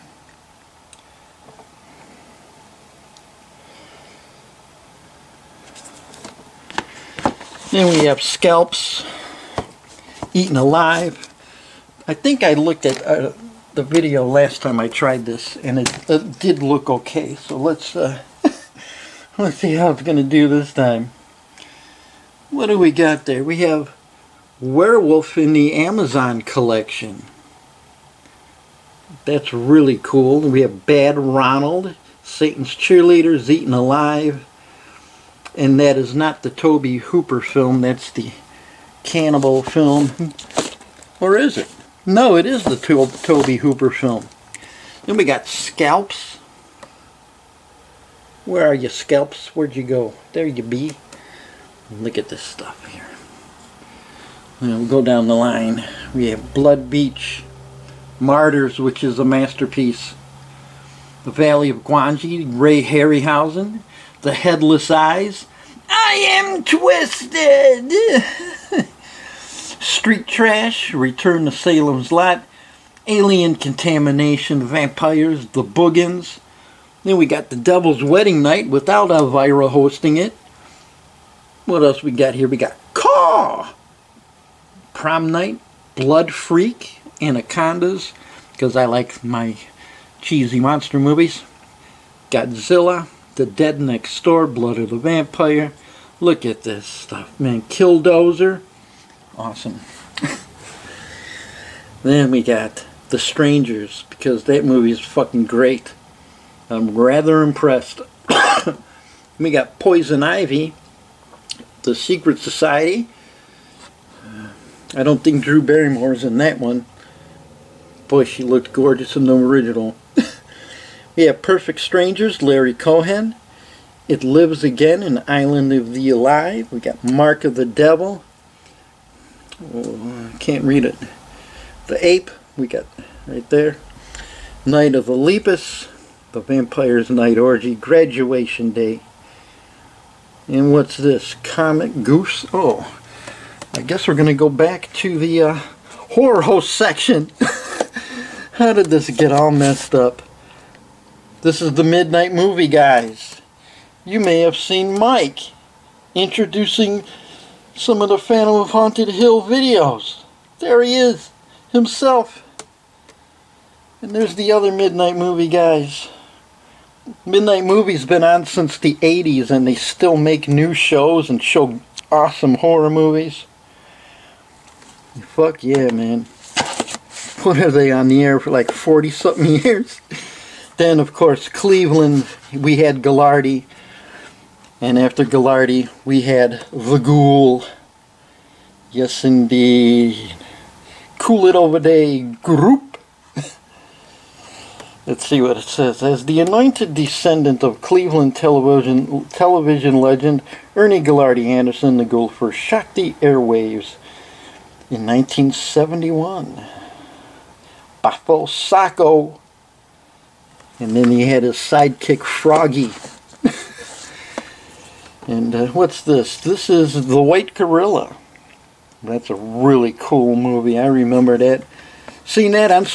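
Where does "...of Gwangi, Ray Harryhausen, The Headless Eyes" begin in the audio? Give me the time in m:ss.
1:01.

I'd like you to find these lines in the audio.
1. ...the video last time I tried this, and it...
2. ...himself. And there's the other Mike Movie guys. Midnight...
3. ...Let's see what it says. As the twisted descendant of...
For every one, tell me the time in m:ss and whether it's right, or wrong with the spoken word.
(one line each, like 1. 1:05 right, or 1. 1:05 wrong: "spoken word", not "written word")
1. 0:13 right
2. 2:41 wrong: "Midnight", not "Mike"
3. 3:15 wrong: "anointed", not "twisted".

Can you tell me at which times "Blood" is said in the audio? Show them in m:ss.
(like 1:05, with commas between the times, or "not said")
0:56, 1:25, 1:34.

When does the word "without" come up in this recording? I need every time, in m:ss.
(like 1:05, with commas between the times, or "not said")
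1:18.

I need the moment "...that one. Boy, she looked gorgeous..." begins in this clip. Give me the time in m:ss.
1:56.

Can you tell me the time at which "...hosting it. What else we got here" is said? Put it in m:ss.
1:19.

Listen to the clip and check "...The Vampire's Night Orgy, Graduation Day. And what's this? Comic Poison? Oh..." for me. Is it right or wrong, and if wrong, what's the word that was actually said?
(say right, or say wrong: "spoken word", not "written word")
wrong: "Goose", not "Poison".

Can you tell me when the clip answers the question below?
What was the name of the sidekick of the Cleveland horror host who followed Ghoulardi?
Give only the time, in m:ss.
3:32.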